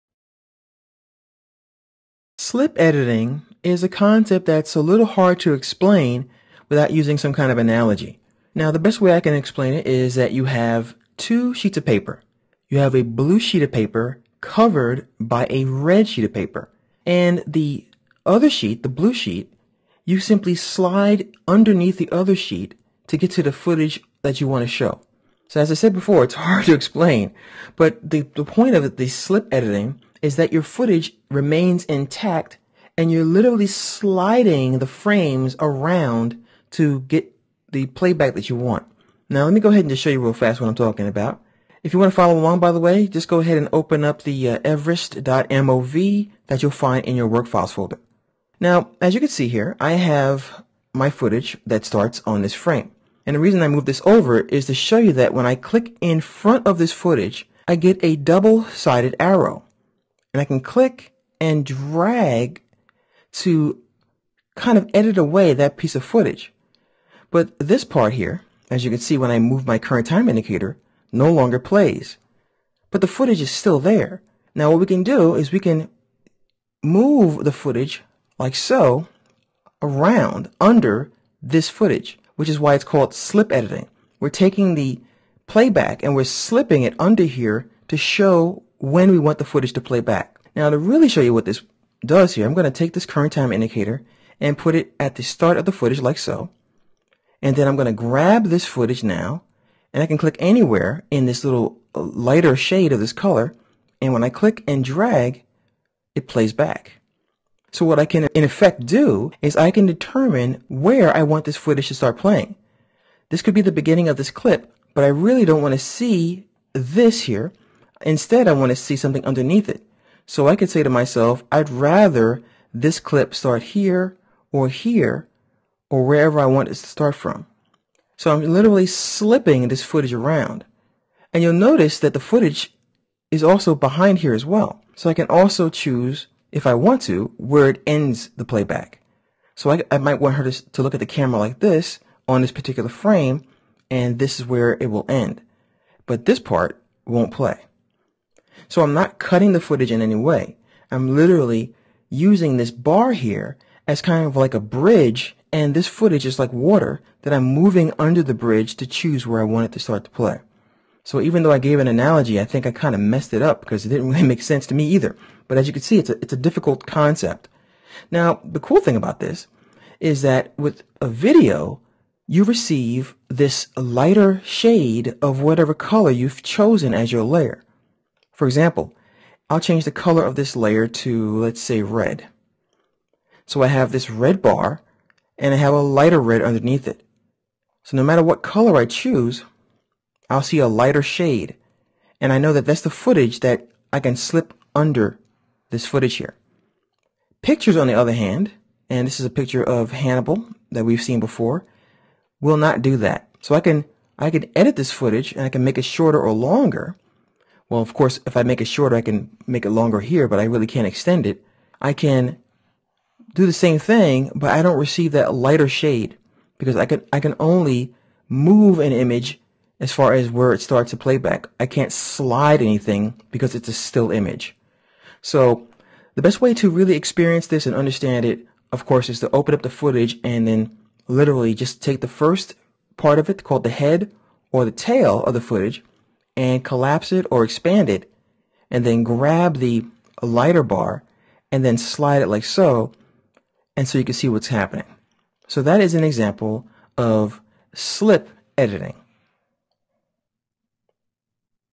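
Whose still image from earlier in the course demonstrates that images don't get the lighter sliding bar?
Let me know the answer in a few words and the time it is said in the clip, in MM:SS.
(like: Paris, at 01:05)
Hannibal, at 03:19.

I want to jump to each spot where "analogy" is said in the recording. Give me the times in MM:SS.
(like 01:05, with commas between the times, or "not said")
00:07, 02:41.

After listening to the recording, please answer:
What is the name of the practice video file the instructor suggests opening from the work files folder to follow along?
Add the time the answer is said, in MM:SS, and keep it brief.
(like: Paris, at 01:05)
everest.mov, at 00:44.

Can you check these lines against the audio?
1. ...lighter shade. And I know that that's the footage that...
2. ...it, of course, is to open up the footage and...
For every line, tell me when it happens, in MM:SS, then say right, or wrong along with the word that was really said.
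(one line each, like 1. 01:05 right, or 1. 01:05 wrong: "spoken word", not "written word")
1. 03:10 right
2. 03:48 right.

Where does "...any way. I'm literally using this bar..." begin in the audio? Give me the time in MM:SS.
02:30.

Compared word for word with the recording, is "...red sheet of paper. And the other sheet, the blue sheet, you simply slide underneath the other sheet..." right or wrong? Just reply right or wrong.
right.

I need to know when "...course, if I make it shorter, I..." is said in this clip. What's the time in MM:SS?
03:27.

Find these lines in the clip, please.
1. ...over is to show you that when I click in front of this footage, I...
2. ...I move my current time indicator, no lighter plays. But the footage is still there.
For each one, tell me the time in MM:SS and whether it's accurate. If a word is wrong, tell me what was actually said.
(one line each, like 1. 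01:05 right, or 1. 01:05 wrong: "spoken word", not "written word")
1. 00:54 right
2. 01:09 wrong: "longer", not "lighter".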